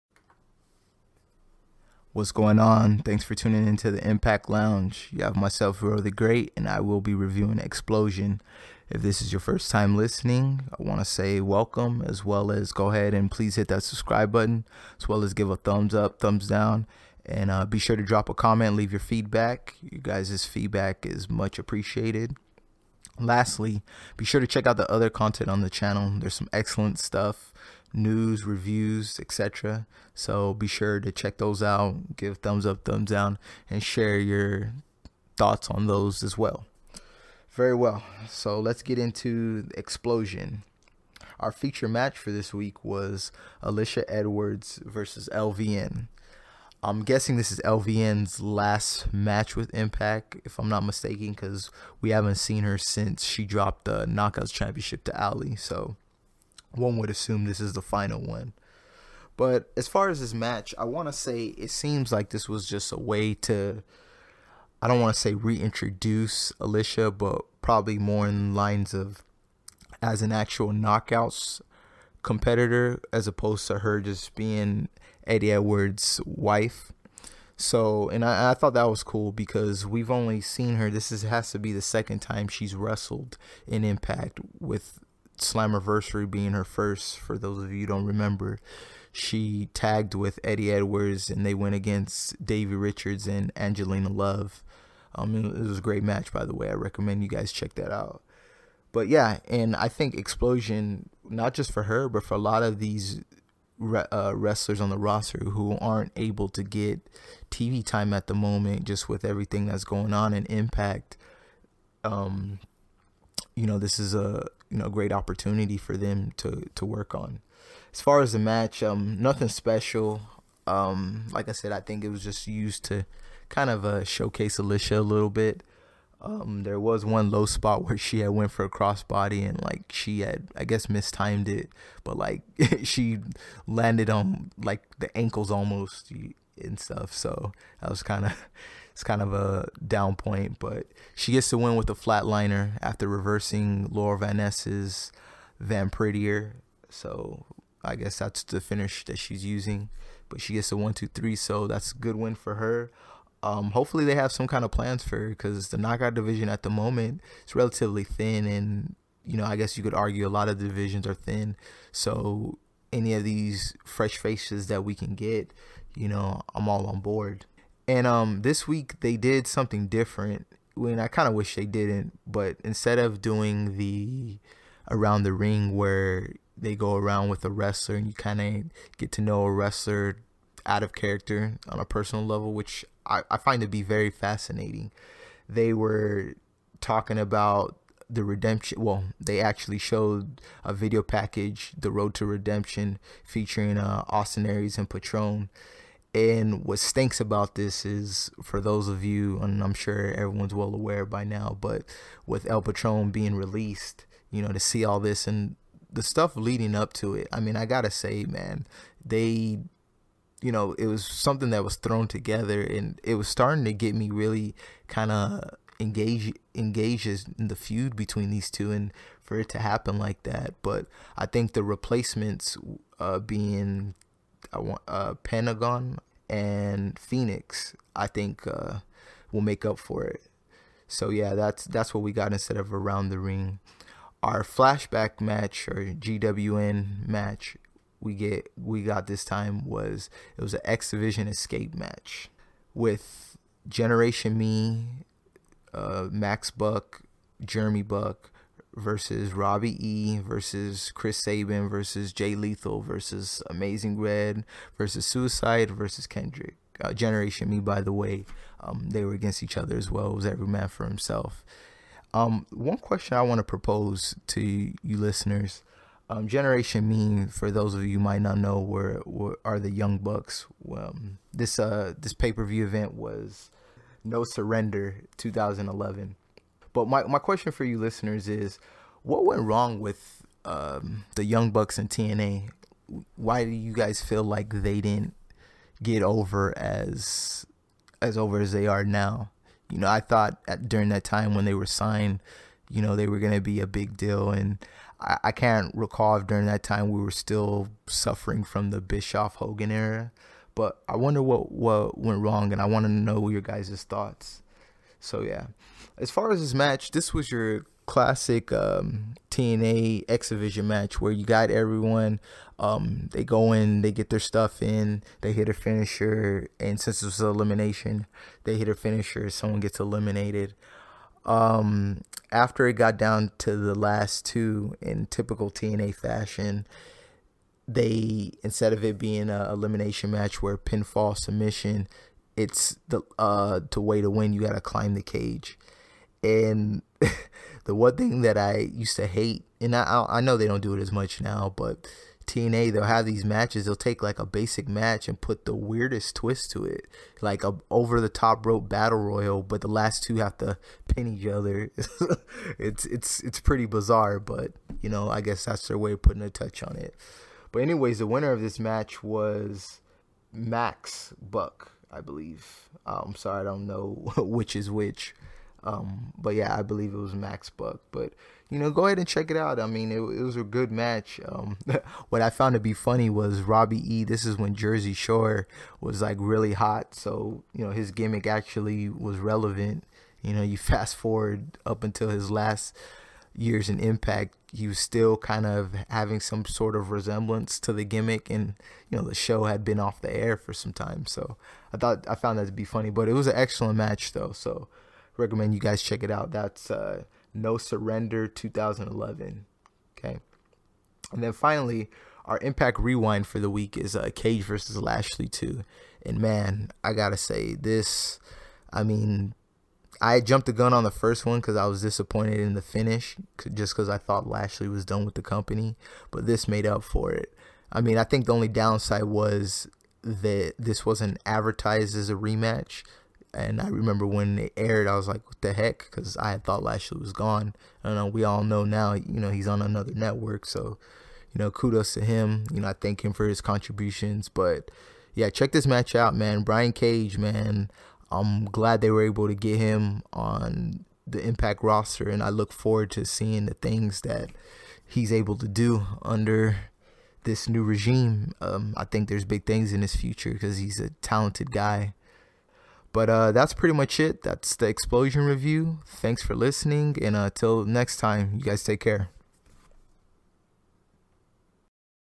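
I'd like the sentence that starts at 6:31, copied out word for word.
So I thought I found that to be funny, but it was an excellent match though.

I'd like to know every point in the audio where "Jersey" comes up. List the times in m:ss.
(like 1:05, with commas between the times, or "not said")
6:14.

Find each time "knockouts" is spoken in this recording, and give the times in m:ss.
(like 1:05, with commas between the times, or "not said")
0:54, 1:10, 2:35.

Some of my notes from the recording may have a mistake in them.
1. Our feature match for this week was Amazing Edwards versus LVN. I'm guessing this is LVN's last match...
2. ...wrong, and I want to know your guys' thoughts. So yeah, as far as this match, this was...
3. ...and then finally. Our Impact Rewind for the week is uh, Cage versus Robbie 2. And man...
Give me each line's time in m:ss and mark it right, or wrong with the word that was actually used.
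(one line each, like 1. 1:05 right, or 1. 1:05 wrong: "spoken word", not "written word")
1. 0:41 wrong: "Alisha", not "Amazing"
2. 5:02 right
3. 6:41 wrong: "Lashley", not "Robbie".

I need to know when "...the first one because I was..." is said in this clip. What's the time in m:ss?
6:50.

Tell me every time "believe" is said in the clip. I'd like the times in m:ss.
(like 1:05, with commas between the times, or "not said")
6:02, 6:06.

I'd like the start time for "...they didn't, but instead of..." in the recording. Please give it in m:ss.
2:51.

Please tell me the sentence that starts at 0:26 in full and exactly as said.
There's some excellent stuff news, reviews, etc.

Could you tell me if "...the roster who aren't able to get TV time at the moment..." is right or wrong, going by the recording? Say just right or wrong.
right.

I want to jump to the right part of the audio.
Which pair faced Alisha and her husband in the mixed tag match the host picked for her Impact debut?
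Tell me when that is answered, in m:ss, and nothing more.
1:32.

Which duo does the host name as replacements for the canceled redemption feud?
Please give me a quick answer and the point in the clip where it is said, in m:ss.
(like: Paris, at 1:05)
Pentagon and Fenix, at 3:45.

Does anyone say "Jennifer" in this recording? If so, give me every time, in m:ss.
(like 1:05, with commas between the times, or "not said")
not said.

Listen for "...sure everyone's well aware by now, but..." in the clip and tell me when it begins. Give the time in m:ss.
3:19.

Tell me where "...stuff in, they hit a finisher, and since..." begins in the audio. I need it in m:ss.
5:14.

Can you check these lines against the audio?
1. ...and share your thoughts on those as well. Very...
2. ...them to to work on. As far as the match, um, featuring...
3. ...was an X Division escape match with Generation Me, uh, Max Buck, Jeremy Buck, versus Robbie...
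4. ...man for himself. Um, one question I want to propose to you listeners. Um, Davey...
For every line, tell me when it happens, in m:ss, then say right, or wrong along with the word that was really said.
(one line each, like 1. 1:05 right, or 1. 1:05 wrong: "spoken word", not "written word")
1. 0:33 right
2. 1:55 wrong: "nothing", not "featuring"
3. 4:00 right
4. 4:20 wrong: "Generation", not "Davey".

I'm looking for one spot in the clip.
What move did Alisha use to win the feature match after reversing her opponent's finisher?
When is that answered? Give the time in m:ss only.
2:21.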